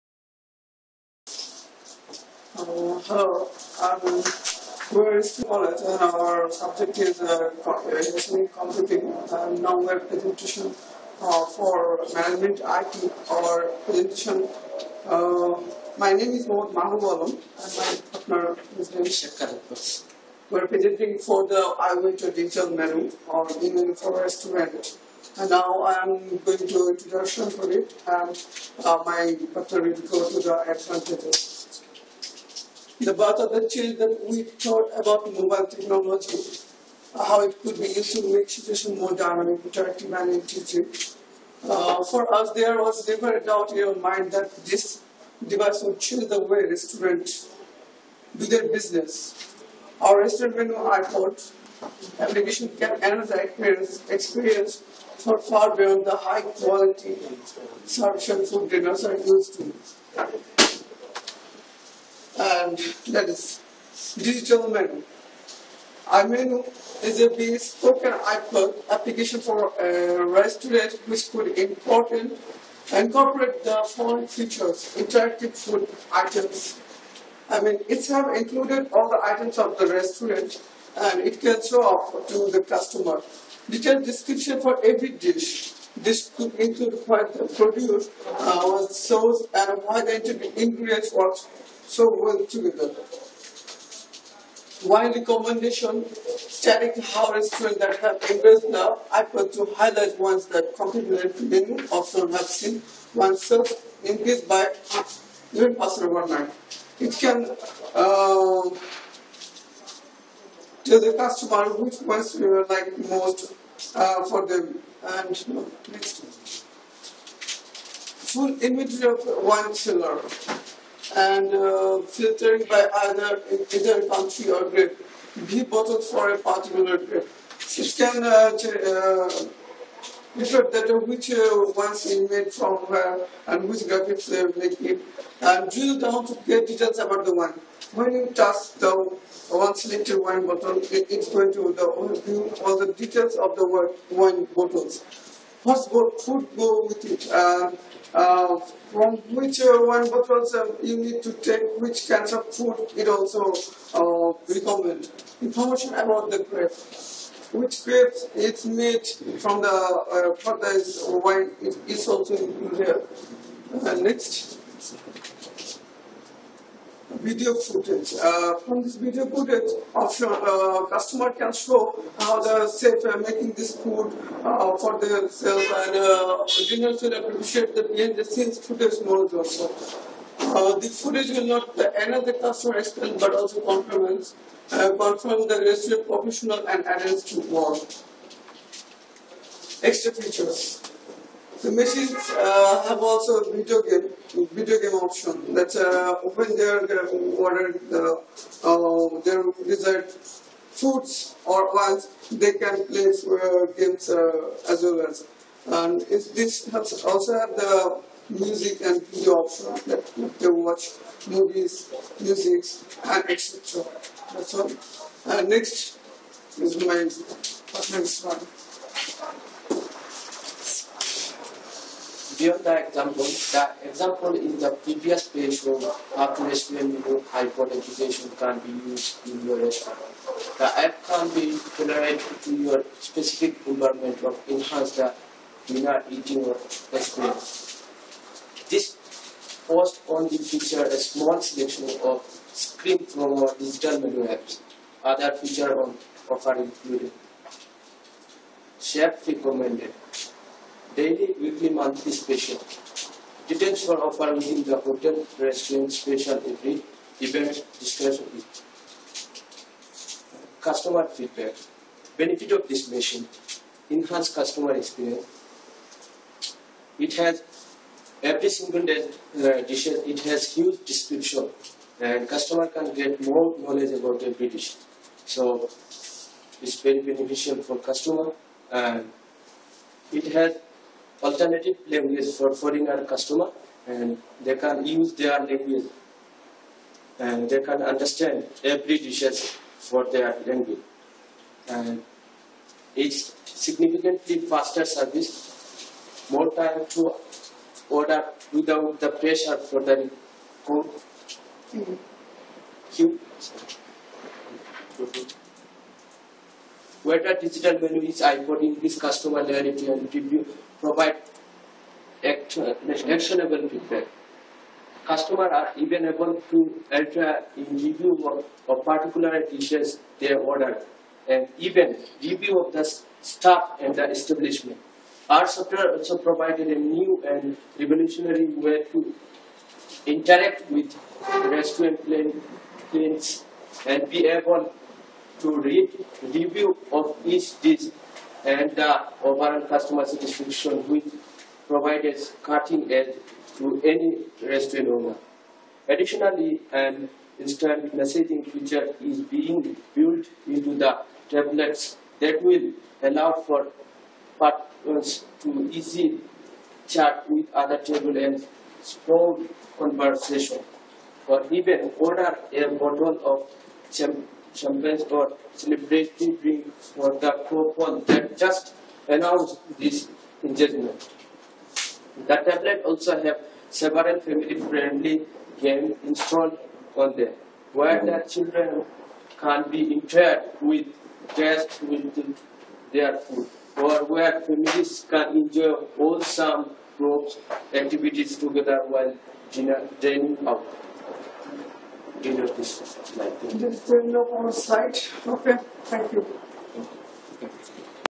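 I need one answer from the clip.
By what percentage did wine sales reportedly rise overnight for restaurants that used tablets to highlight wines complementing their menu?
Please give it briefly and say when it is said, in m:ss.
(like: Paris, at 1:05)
11%, at 1:45.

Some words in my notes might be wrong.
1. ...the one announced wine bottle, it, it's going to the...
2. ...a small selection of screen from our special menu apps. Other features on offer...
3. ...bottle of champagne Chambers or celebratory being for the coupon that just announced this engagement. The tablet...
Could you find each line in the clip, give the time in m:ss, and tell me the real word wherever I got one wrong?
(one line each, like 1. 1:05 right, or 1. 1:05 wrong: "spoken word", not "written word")
1. 2:18 wrong: "selected", not "announced"
2. 4:00 wrong: "digital", not "special"
3. 6:02 right.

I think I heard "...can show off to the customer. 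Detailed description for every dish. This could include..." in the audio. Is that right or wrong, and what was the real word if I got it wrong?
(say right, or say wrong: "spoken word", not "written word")
right.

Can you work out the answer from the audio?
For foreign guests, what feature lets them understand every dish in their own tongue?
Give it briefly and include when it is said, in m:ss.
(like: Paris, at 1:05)
alternative language, at 4:41.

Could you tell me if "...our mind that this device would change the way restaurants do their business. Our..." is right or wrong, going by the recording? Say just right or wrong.
right.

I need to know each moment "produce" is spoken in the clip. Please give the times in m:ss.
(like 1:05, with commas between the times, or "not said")
1:27.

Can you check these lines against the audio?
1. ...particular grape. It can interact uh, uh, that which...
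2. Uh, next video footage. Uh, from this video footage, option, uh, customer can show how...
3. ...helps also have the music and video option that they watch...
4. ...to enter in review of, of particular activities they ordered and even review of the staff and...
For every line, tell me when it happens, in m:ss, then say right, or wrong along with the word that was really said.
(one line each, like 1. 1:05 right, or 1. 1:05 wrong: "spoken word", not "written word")
1. 2:06 wrong: "reflect", not "interact"
2. 2:43 right
3. 3:26 right
4. 5:16 wrong: "dishes", not "activities".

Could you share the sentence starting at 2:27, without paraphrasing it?
uh, from which uh, one bottle you need to take which kinds of food it also uh, recommend.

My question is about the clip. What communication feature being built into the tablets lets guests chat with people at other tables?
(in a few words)
instant messaging.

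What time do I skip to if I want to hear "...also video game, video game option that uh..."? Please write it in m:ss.
3:13.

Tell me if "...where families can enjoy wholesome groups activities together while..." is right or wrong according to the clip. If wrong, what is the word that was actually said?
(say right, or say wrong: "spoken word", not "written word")
right.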